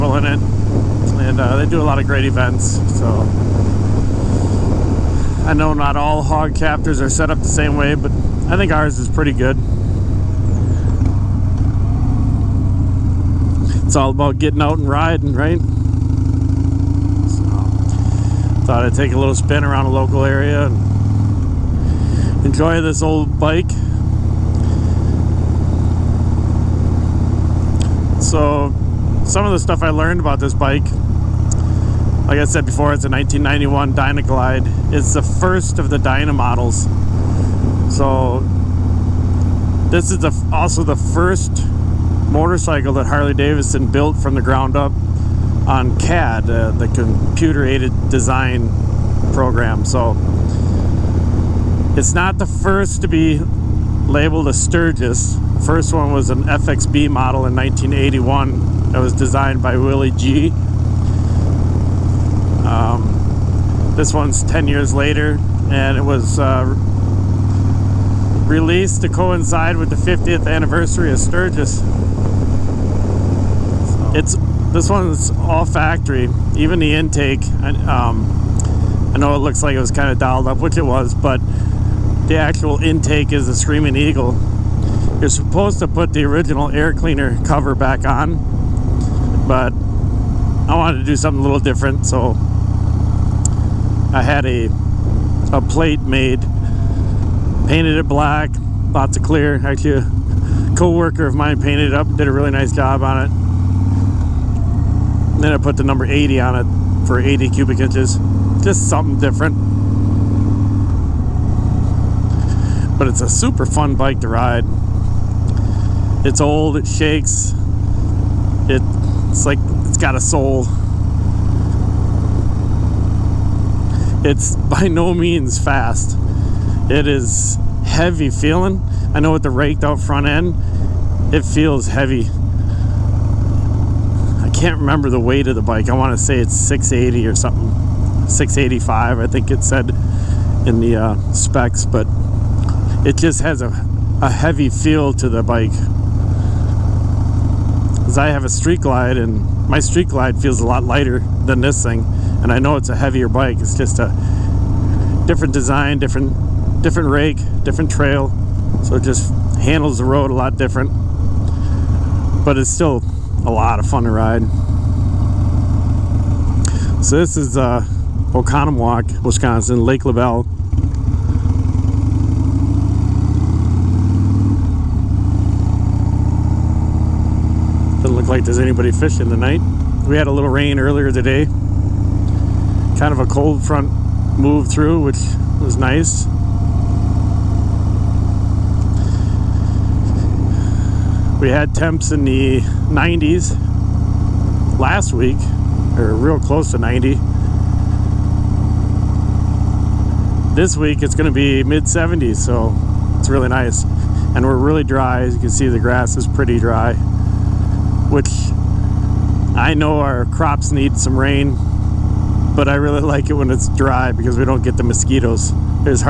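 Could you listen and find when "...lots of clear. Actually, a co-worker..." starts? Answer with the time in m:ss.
1:38.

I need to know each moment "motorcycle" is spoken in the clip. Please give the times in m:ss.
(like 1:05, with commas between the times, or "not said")
0:42.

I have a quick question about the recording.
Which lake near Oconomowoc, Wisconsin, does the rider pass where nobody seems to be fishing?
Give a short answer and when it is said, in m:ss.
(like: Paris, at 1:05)
Lake Labelle, at 2:49.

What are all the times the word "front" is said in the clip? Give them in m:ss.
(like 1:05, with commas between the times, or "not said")
2:10, 3:03.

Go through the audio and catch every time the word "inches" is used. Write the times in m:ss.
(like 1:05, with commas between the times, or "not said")
1:47.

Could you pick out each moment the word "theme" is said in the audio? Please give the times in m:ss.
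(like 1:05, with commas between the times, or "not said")
not said.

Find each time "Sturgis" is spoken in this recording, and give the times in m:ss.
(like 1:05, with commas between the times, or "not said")
0:54, 1:11.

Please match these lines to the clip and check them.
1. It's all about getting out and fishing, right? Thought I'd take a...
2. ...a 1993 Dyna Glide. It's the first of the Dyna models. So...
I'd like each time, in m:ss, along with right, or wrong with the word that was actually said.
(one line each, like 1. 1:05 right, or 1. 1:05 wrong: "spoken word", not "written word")
1. 0:13 wrong: "riding", not "fishing"
2. 0:33 wrong: "1991", not "1993".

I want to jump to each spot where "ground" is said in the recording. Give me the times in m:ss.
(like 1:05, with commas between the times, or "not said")
0:44.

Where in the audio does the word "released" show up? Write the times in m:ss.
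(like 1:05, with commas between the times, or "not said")
1:08.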